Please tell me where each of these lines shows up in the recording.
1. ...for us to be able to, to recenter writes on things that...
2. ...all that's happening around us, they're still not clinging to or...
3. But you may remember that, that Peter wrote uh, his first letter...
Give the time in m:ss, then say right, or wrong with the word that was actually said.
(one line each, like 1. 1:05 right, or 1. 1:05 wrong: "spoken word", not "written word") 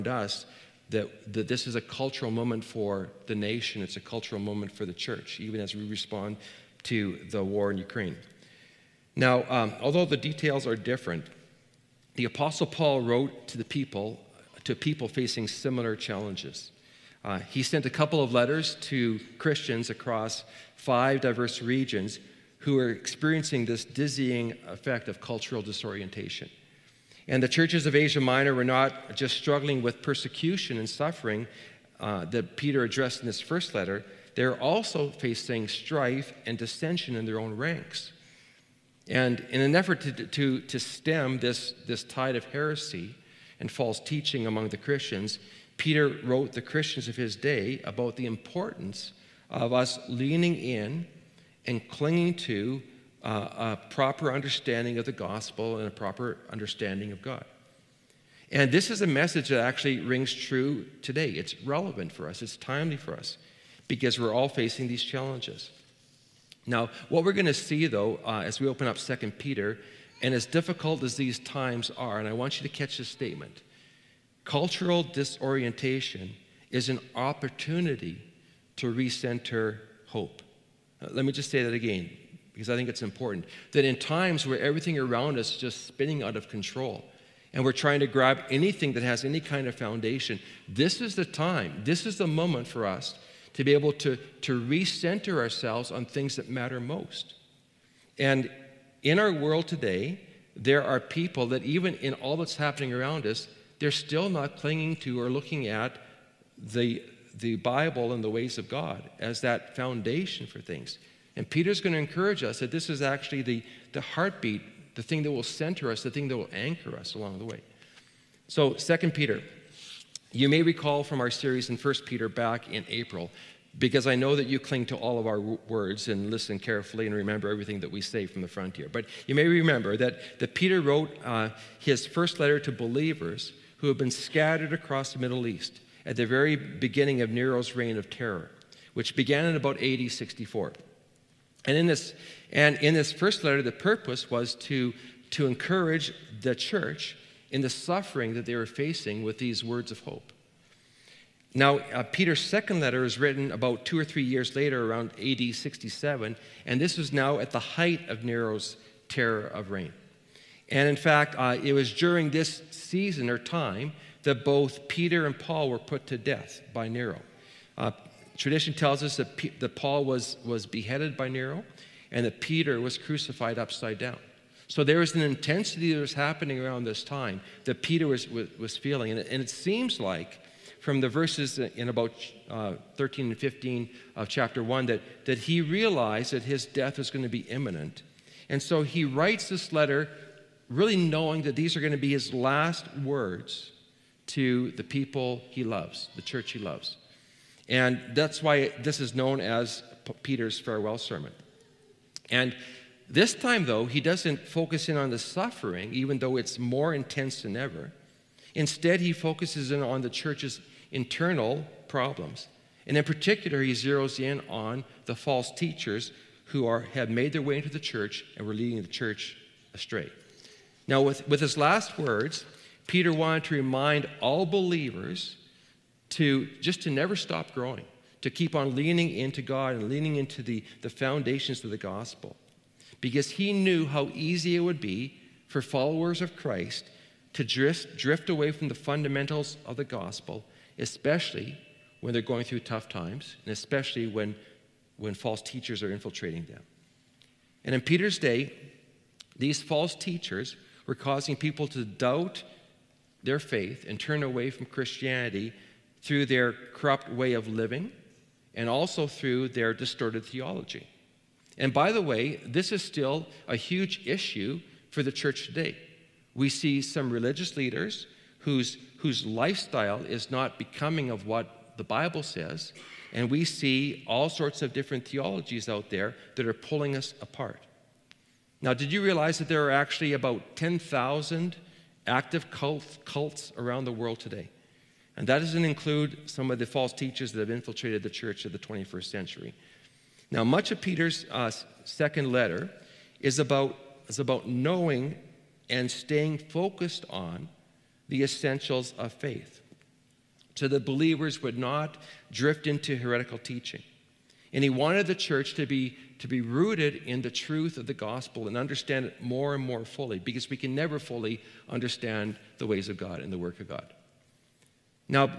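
1. 1:32 wrong: "ourselves", not "writes"
2. 1:42 right
3. 2:08 right.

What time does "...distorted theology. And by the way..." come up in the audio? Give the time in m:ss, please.
4:19.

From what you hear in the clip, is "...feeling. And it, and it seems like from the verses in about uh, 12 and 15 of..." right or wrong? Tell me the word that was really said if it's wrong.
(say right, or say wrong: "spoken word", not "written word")
wrong: "13", not "12".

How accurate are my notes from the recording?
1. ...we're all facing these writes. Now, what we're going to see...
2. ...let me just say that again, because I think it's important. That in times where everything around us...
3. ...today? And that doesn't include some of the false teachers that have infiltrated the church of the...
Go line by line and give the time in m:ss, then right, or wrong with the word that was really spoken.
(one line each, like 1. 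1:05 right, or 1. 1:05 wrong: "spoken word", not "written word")
1. 1:04 wrong: "challenges", not "writes"
2. 1:21 right
3. 4:44 right.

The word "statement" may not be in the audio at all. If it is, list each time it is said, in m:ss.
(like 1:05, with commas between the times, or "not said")
1:13.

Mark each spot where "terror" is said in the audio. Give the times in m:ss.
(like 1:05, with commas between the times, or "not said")
2:18, 2:39.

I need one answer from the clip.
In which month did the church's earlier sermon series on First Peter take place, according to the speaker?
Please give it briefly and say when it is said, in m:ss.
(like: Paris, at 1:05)
April, at 2:02.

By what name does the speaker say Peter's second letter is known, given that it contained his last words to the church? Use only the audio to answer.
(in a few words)
Peter's farewell sermon.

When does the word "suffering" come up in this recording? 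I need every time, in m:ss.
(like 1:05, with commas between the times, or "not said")
0:30, 2:27, 3:25.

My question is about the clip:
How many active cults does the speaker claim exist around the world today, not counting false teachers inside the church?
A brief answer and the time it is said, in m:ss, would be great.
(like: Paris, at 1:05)
10,000, at 4:40.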